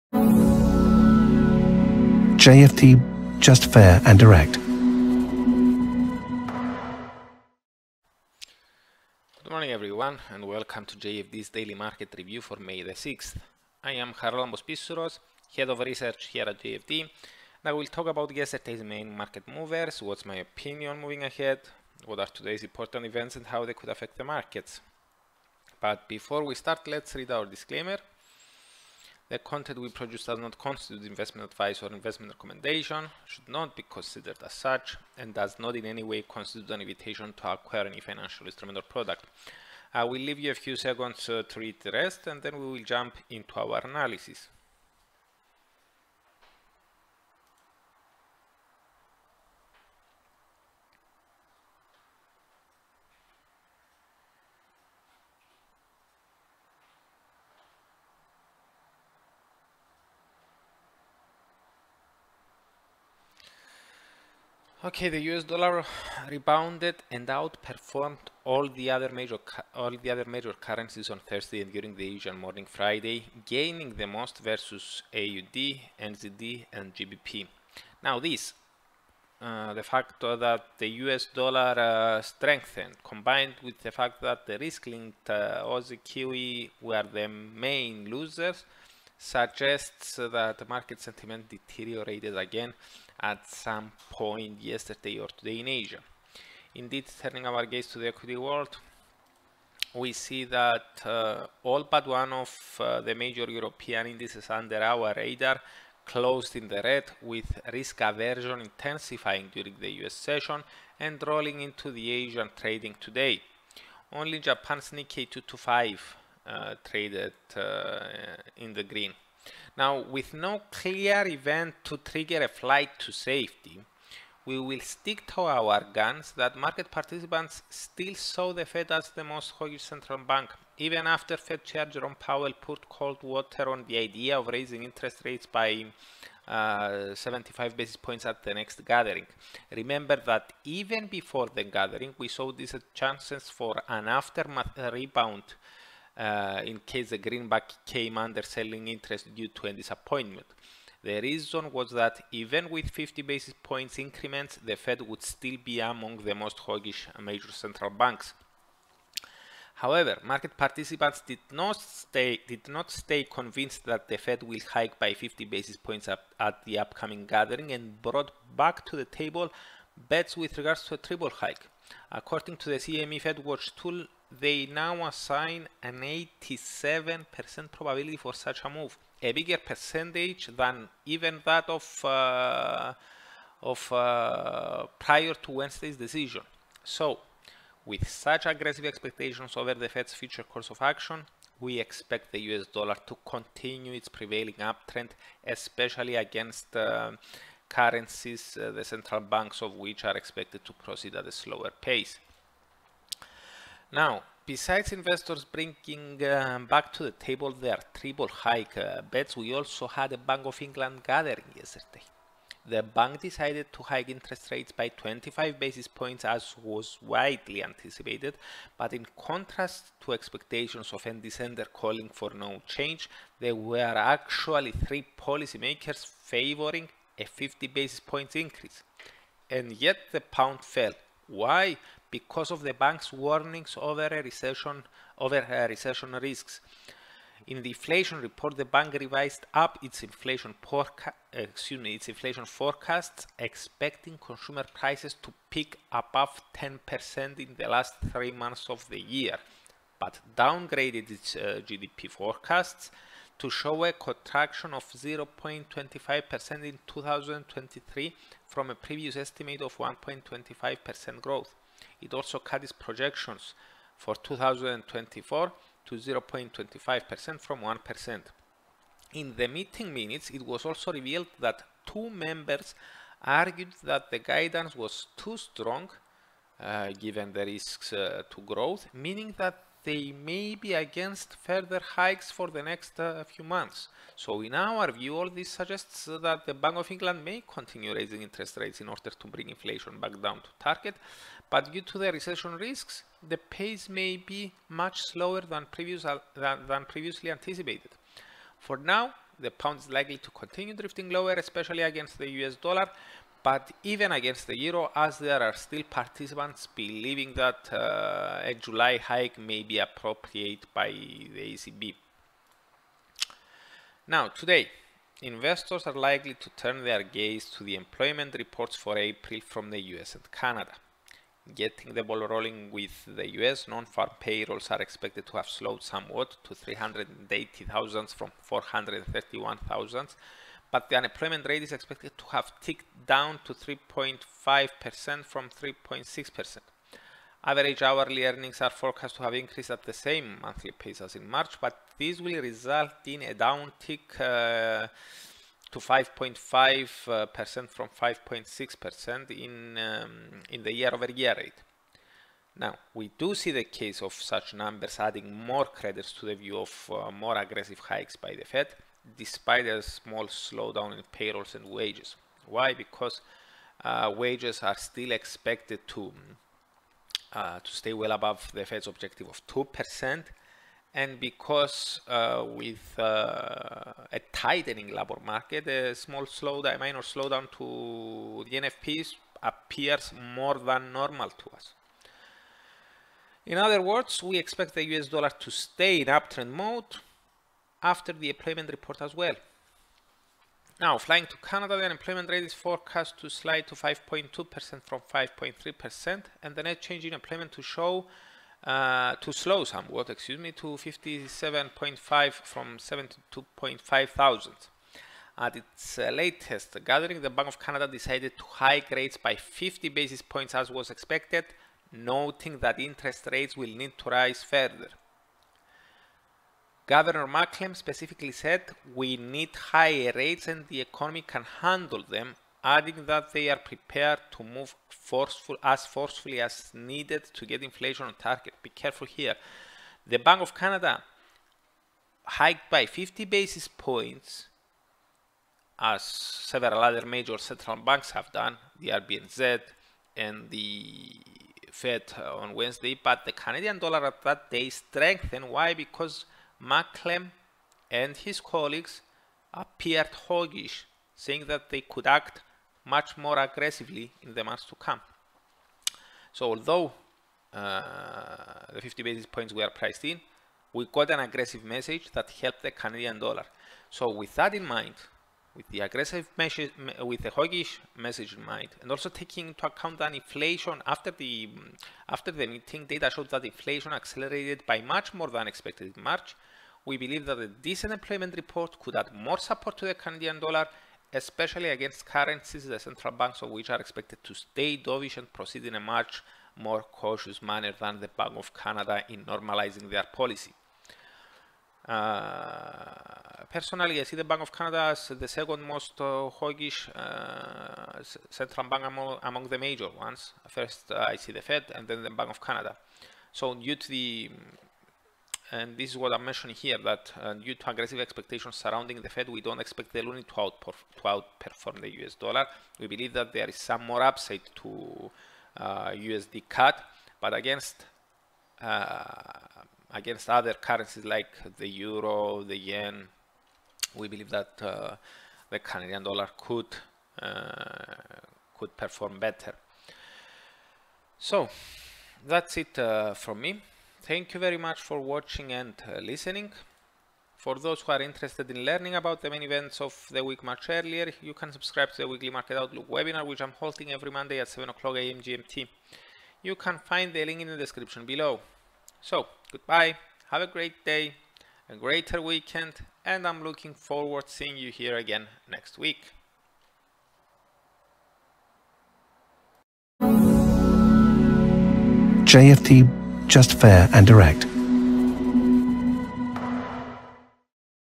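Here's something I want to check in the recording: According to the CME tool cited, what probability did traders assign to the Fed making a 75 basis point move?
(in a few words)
87%.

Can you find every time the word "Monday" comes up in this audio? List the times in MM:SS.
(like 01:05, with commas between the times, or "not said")
09:04.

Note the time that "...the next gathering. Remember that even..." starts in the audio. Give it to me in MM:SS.
02:18.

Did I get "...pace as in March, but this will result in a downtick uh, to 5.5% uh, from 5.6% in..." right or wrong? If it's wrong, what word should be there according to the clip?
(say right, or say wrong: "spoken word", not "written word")
right.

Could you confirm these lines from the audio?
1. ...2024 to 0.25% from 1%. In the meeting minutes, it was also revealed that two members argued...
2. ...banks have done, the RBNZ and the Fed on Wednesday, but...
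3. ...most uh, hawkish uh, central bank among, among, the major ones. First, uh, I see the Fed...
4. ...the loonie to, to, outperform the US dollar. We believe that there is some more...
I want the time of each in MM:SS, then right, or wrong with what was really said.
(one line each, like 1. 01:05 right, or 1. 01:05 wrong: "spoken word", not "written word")
1. 04:24 right
2. 07:17 right
3. 08:15 right
4. 08:29 right.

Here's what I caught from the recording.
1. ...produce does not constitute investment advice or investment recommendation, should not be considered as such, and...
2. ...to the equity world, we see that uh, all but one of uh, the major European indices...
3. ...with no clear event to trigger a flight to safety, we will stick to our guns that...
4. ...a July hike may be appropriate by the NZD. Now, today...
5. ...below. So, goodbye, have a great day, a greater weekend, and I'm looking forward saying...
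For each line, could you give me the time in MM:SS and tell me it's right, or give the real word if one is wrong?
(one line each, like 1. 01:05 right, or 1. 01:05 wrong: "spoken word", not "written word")
1. 00:29 right
2. 01:37 right
3. 02:00 right
4. 05:08 wrong: "ECB", not "NZD"
5. 09:08 wrong: "seeing", not "saying".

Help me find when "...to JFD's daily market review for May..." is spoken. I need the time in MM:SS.
00:10.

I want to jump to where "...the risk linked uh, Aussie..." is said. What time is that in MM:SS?
01:24.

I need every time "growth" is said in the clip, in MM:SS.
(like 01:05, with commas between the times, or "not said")
04:21, 04:38.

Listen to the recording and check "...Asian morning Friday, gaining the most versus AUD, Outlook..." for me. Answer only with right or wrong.
wrong.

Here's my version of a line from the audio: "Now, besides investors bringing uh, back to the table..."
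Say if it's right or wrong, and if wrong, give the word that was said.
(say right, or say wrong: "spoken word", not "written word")
right.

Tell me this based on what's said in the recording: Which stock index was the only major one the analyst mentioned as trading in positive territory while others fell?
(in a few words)
Nikkei 225.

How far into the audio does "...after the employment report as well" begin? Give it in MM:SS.
06:27.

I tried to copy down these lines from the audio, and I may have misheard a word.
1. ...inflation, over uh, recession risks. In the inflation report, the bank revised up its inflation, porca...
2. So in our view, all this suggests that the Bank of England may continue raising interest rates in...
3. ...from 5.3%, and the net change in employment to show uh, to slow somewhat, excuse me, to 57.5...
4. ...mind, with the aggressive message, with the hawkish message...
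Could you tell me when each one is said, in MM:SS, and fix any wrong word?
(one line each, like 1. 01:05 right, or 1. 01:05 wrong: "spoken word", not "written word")
1. 03:54 wrong: "recession", not "inflation"
2. 04:44 right
3. 06:34 right
4. 07:44 right.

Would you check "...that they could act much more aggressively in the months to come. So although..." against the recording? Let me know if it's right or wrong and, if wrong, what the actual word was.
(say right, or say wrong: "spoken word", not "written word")
right.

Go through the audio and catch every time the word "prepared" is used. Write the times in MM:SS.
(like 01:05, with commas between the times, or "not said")
07:03.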